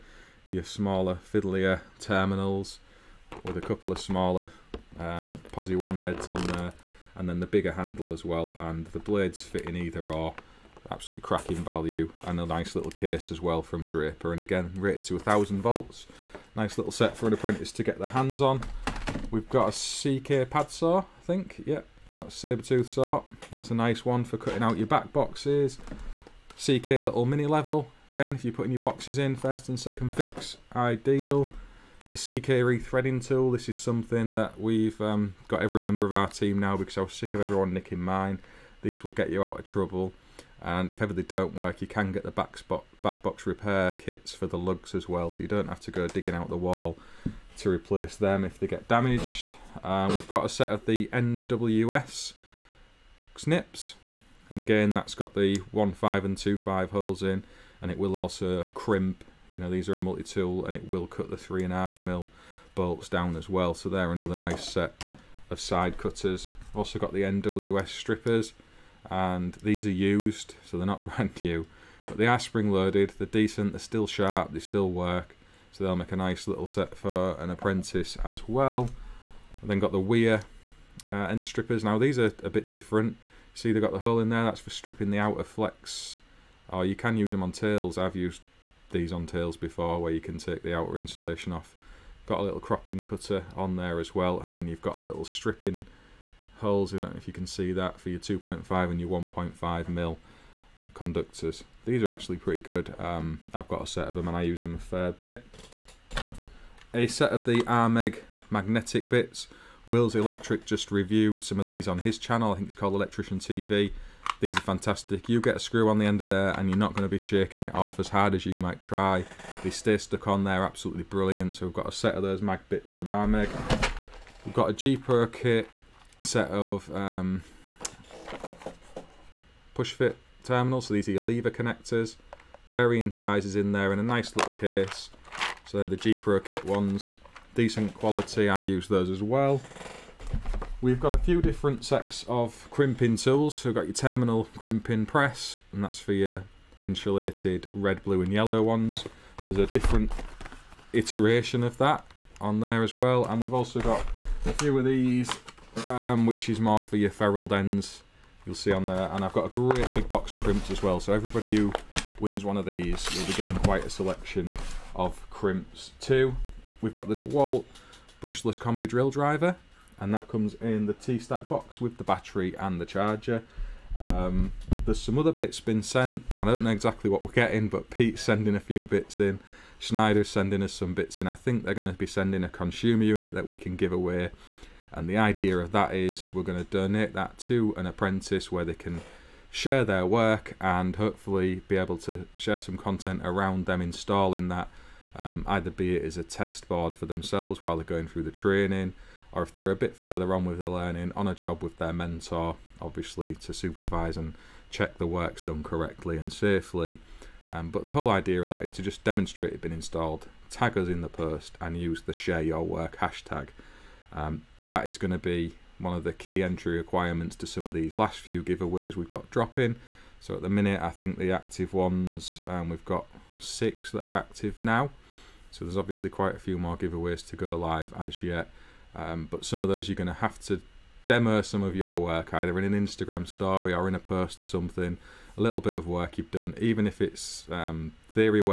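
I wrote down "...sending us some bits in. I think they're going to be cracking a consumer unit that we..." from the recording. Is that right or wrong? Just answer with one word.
wrong.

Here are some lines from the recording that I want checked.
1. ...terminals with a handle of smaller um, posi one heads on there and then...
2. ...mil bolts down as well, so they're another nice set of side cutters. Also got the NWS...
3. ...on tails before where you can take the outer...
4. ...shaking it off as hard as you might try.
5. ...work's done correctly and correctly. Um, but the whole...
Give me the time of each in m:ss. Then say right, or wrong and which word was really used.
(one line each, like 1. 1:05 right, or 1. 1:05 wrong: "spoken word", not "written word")
1. 0:01 wrong: "couple", not "handle"
2. 1:02 right
3. 1:29 right
4. 1:57 right
5. 3:25 wrong: "safely", not "correctly".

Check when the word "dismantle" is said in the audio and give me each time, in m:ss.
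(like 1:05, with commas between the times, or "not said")
not said.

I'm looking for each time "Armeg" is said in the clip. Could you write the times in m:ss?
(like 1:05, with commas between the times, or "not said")
1:47, 2:03.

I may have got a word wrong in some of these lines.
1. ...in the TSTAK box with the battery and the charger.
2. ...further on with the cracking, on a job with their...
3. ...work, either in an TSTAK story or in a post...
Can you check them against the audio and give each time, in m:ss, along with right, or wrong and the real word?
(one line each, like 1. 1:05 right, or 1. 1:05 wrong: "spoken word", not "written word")
1. 2:50 right
2. 3:19 wrong: "learning", not "cracking"
3. 3:51 wrong: "Instagram", not "TSTAK".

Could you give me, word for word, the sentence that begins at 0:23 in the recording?
That's a nice one for cutting out your back boxes.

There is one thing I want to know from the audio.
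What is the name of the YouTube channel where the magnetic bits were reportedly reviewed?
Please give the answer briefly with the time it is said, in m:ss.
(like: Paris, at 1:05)
Electrician TV, at 1:52.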